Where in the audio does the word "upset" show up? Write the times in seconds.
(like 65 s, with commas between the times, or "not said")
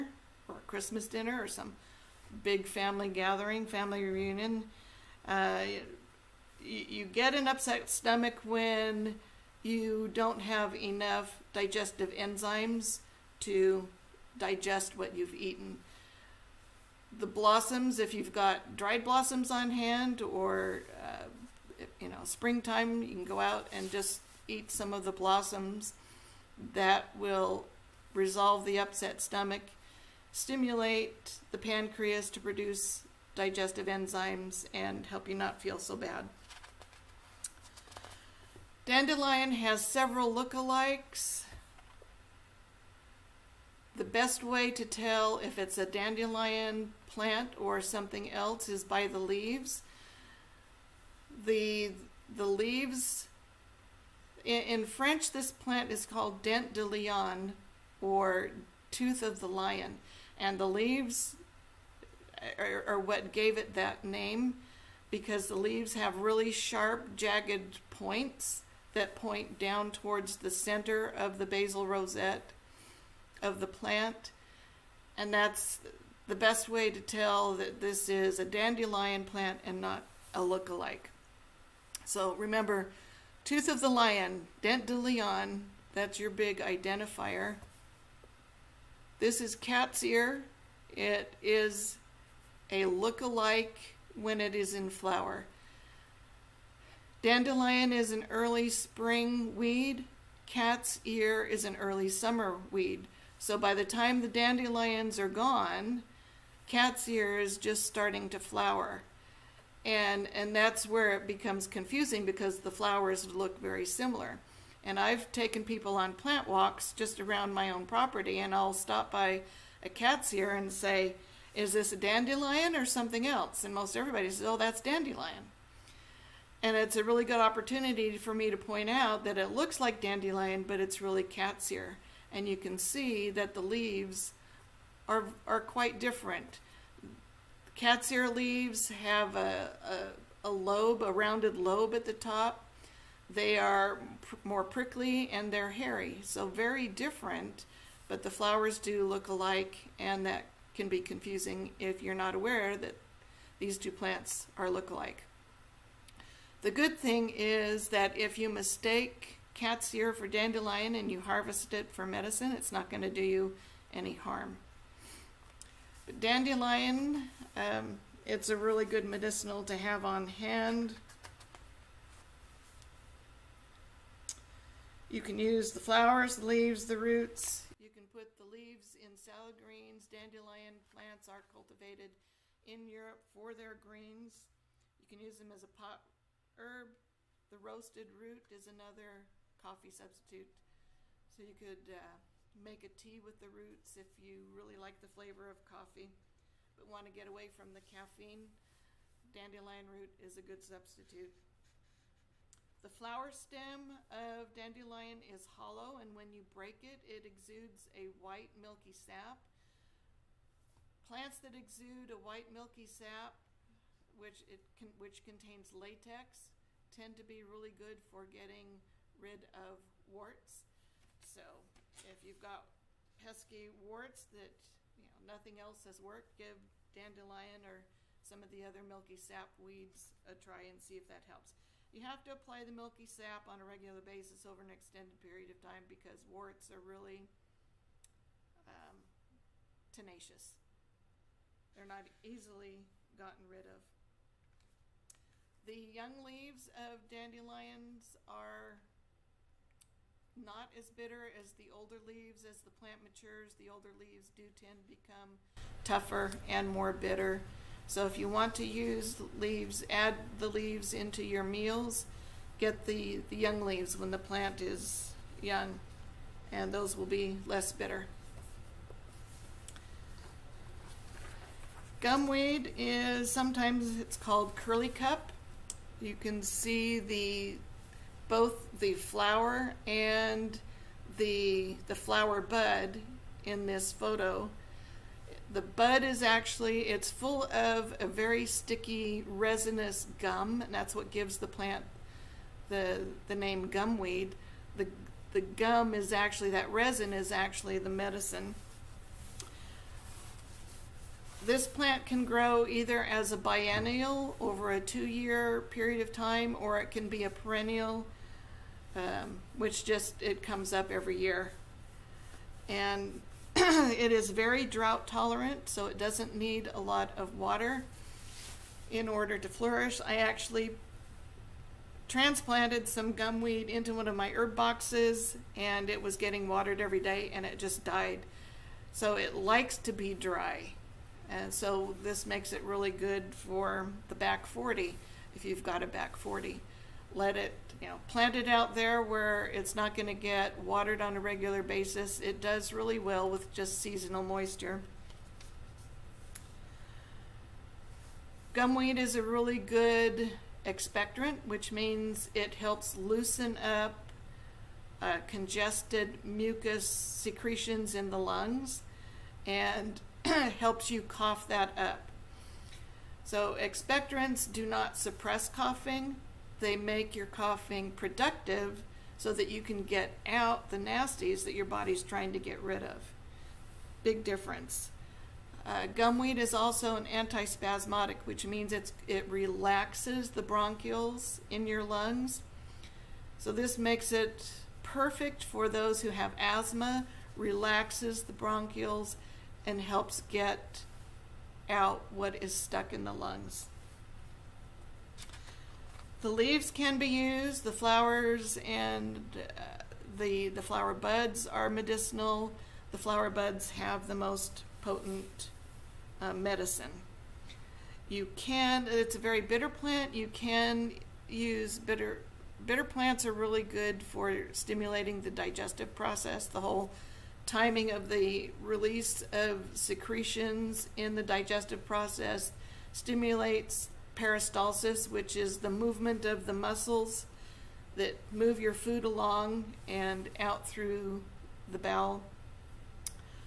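7 s, 28 s.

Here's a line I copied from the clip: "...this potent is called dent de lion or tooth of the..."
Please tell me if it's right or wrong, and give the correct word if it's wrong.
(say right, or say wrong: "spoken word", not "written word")
wrong: "plant", not "potent".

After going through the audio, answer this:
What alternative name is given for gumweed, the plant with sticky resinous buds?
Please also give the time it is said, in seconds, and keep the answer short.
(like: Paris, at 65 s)
curly cup, at 274 s.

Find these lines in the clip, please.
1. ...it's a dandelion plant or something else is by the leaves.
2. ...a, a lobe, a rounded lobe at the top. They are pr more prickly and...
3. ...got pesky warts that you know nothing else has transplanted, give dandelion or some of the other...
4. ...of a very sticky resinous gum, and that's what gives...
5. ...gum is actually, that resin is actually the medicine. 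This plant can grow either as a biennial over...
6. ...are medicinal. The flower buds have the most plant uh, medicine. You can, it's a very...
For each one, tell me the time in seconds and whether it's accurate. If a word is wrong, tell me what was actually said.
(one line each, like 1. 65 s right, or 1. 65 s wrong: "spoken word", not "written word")
1. 45 s right
2. 140 s right
3. 222 s wrong: "worked", not "transplanted"
4. 287 s right
5. 295 s right
6. 401 s wrong: "potent", not "plant".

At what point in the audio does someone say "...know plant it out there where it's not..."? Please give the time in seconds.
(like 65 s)
337 s.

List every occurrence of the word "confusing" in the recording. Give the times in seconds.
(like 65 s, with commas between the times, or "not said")
111 s, 151 s.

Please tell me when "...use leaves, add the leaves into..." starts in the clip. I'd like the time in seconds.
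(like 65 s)
258 s.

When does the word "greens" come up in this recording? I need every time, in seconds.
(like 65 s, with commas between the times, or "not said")
179 s, 183 s.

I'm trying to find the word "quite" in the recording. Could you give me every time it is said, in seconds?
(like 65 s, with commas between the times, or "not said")
135 s.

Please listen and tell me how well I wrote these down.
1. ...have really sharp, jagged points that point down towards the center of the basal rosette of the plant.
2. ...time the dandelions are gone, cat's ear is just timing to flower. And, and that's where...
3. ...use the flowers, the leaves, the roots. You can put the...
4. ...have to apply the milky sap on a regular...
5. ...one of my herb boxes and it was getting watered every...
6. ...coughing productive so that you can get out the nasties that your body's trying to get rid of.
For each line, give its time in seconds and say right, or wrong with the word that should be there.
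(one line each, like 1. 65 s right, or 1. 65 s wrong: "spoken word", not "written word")
1. 65 s right
2. 103 s wrong: "starting", not "timing"
3. 175 s right
4. 232 s right
5. 323 s right
6. 367 s right.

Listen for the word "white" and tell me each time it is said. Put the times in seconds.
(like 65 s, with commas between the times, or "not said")
208 s, 212 s.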